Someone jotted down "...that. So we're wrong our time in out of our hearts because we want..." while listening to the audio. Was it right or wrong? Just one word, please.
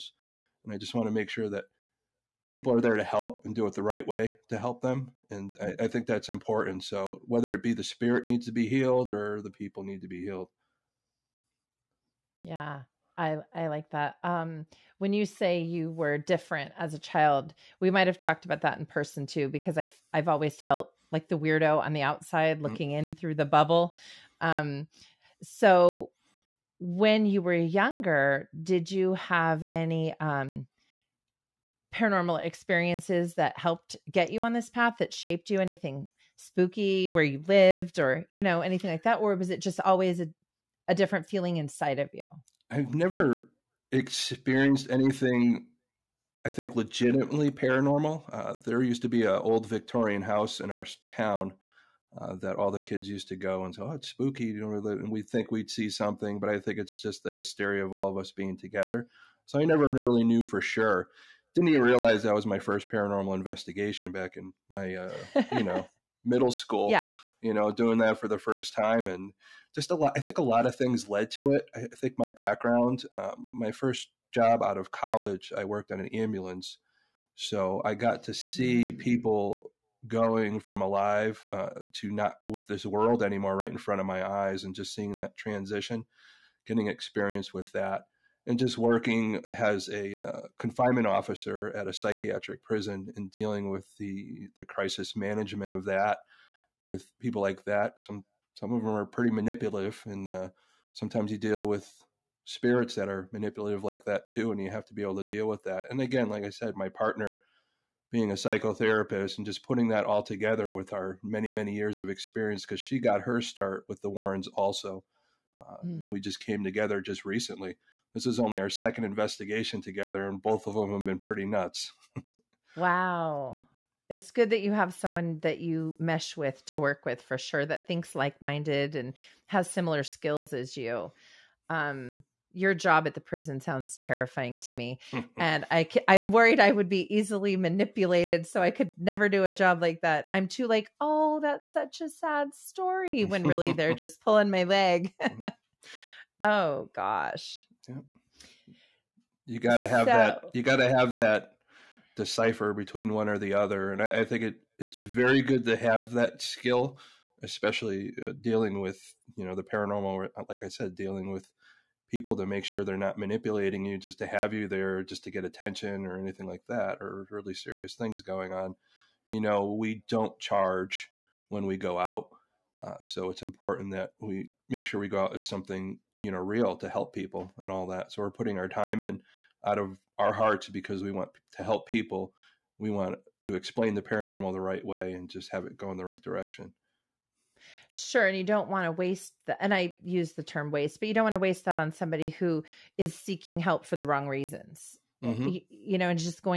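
wrong.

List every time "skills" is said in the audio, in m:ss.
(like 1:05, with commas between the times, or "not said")
2:10, 2:36.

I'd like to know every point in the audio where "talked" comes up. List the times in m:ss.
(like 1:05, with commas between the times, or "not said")
0:18.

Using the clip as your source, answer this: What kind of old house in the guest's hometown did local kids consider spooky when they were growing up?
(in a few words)
Victorian house.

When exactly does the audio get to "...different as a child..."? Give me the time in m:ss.
0:16.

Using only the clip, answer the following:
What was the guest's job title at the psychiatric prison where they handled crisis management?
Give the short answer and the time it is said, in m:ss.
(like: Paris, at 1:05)
Confinement officer, at 1:30.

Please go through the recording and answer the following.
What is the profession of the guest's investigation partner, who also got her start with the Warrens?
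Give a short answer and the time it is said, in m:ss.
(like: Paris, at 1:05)
Psychotherapist, at 1:48.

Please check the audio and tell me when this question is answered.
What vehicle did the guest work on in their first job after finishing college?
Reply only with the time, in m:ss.
1:16.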